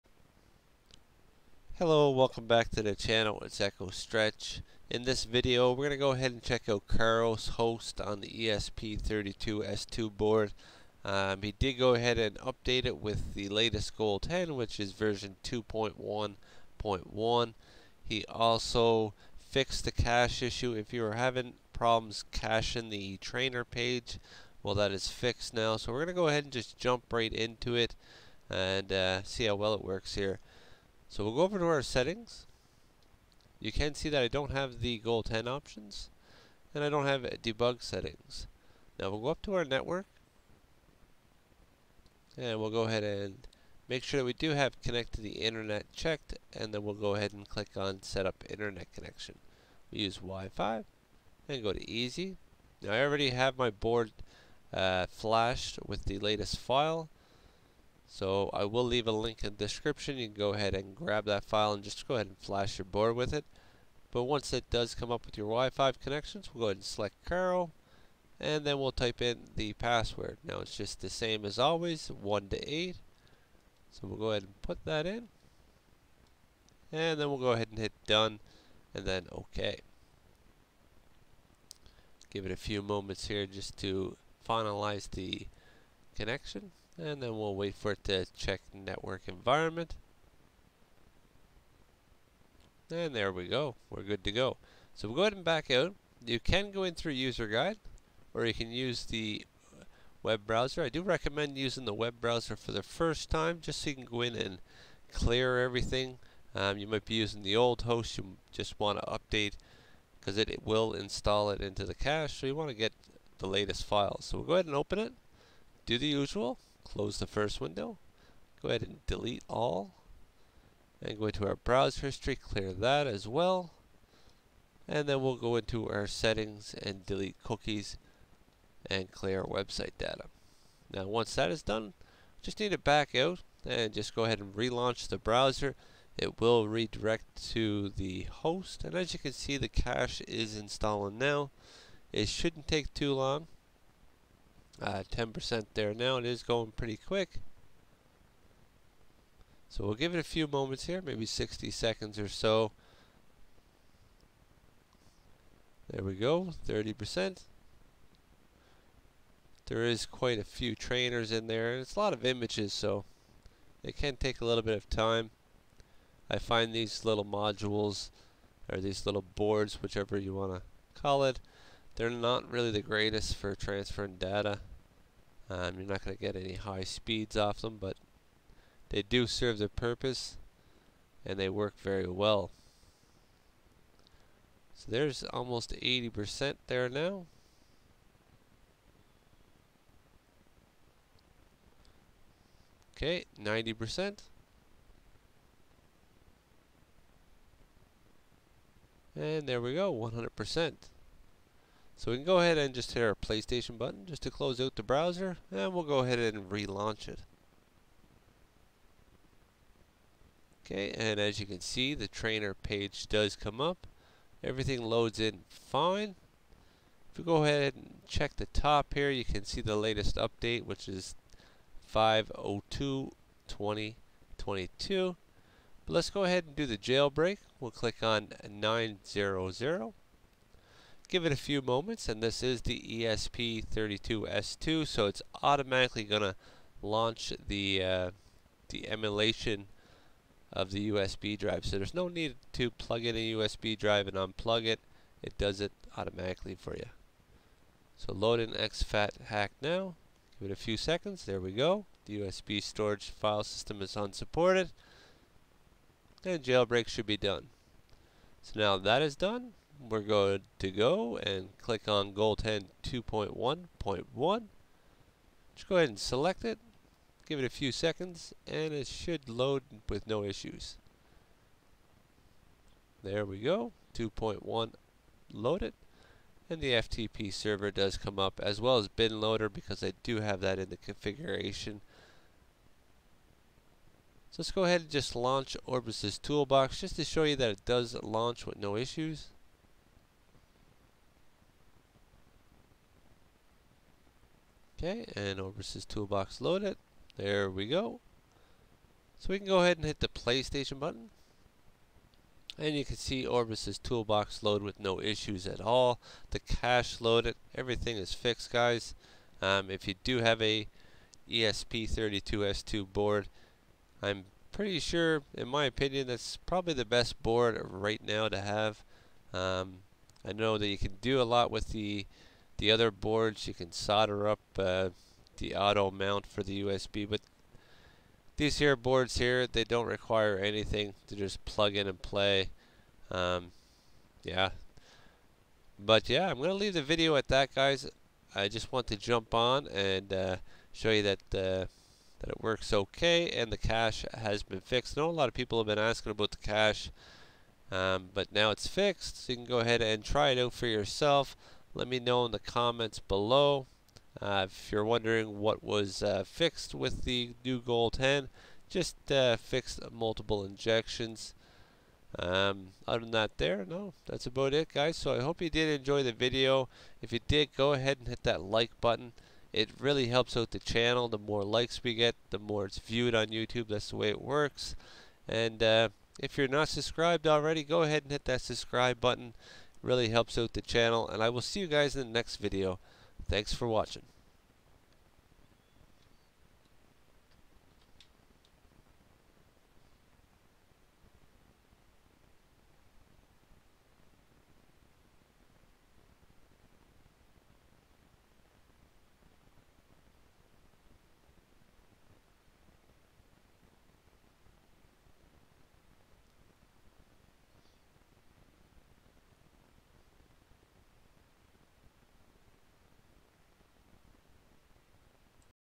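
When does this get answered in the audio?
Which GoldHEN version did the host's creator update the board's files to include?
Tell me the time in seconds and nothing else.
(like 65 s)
14 s.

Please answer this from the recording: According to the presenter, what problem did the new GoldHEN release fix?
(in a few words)
multiple injections.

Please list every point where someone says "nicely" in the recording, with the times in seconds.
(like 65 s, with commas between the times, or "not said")
not said.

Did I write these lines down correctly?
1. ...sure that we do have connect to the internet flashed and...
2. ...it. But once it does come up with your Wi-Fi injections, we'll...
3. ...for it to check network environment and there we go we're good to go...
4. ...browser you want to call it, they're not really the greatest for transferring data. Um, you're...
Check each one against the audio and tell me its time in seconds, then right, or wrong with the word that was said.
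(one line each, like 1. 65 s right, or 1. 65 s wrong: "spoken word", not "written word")
1. 44 s wrong: "checked", not "flashed"
2. 63 s wrong: "connections", not "injections"
3. 87 s right
4. 169 s wrong: "whichever", not "browser".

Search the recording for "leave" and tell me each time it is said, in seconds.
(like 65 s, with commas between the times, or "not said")
58 s, 336 s.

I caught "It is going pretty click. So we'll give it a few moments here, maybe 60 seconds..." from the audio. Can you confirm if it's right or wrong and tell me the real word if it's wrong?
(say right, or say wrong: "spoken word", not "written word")
wrong: "quick", not "click".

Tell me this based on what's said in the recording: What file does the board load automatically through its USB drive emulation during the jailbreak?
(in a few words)
exfathax.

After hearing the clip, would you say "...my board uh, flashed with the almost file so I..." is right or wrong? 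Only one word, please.
wrong.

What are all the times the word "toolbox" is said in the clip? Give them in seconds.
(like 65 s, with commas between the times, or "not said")
286 s, 295 s, 303 s.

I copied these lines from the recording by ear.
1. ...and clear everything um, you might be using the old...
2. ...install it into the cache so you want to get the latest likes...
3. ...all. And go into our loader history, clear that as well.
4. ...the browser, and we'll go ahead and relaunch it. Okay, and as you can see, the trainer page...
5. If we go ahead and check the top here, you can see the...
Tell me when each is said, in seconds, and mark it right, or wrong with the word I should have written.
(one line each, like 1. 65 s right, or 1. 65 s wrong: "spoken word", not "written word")
1. 104 s right
2. 110 s wrong: "files", not "likes"
3. 119 s wrong: "browser", not "loader"
4. 204 s right
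5. 217 s right.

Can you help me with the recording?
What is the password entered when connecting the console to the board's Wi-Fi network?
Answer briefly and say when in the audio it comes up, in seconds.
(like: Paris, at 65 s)
1 to 8, at 72 s.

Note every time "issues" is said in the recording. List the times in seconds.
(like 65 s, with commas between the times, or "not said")
20 s, 270 s, 288 s, 304 s.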